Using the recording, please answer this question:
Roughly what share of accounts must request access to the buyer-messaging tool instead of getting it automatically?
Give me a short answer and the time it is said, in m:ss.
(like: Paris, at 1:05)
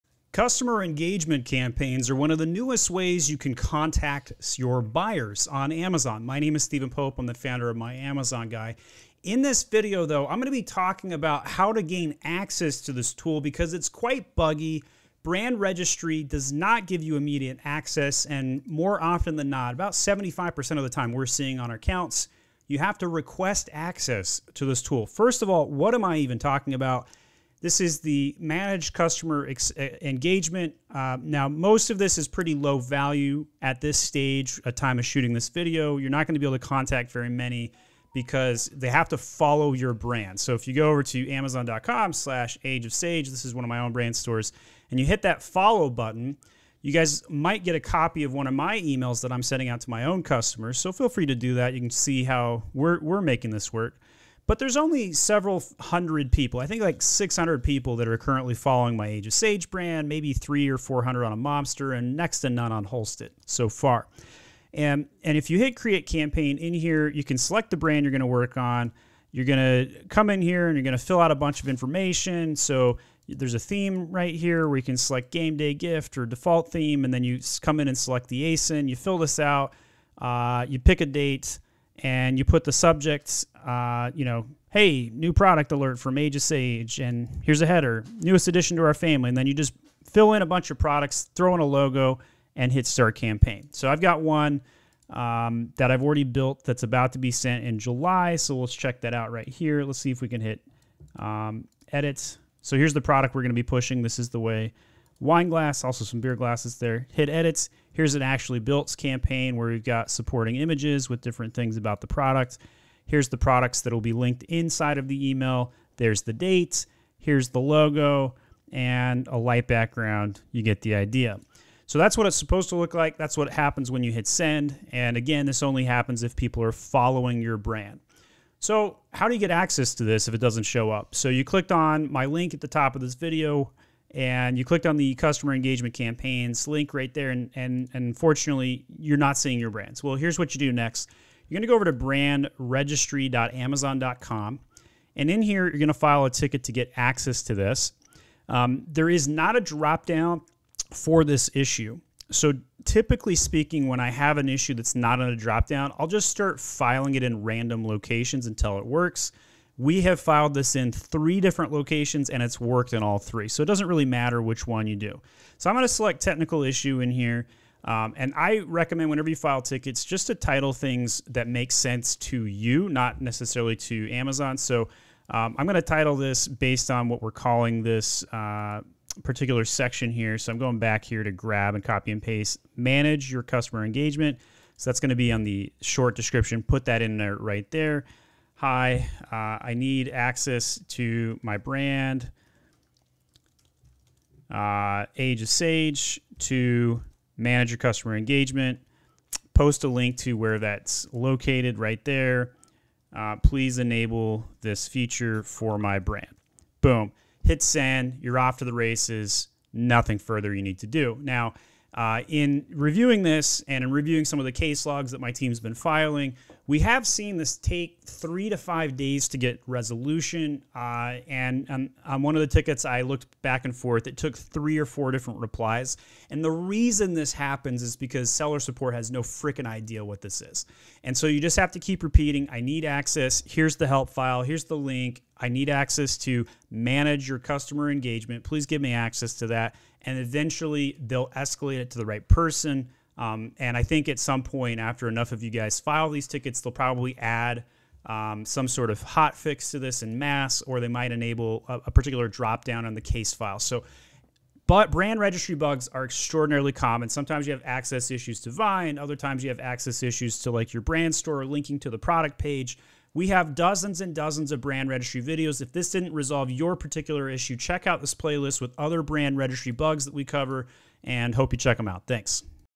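75%, at 0:19.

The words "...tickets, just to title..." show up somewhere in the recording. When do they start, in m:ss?
2:49.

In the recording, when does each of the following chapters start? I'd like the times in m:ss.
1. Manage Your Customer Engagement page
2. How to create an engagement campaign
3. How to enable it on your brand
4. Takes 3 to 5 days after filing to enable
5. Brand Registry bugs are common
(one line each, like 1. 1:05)
1. 0:25
2. 1:04
3. 2:08
4. 3:32
5. 4:14.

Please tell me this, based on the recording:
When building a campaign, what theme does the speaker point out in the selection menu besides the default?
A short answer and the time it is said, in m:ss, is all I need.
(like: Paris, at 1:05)
game day gift, at 1:15.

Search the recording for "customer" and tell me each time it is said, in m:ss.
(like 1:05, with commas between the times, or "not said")
0:00, 0:28, 0:50, 2:15, 3:03, 3:17, 3:57.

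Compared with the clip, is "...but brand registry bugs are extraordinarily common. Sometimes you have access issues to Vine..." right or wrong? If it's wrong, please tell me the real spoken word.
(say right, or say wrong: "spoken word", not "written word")
right.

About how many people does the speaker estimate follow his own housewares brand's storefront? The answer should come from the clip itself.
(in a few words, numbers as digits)
600.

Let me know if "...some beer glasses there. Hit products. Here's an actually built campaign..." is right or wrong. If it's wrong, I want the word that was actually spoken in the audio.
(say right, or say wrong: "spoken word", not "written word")
wrong: "edits", not "products".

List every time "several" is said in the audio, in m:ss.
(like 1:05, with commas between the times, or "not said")
0:55.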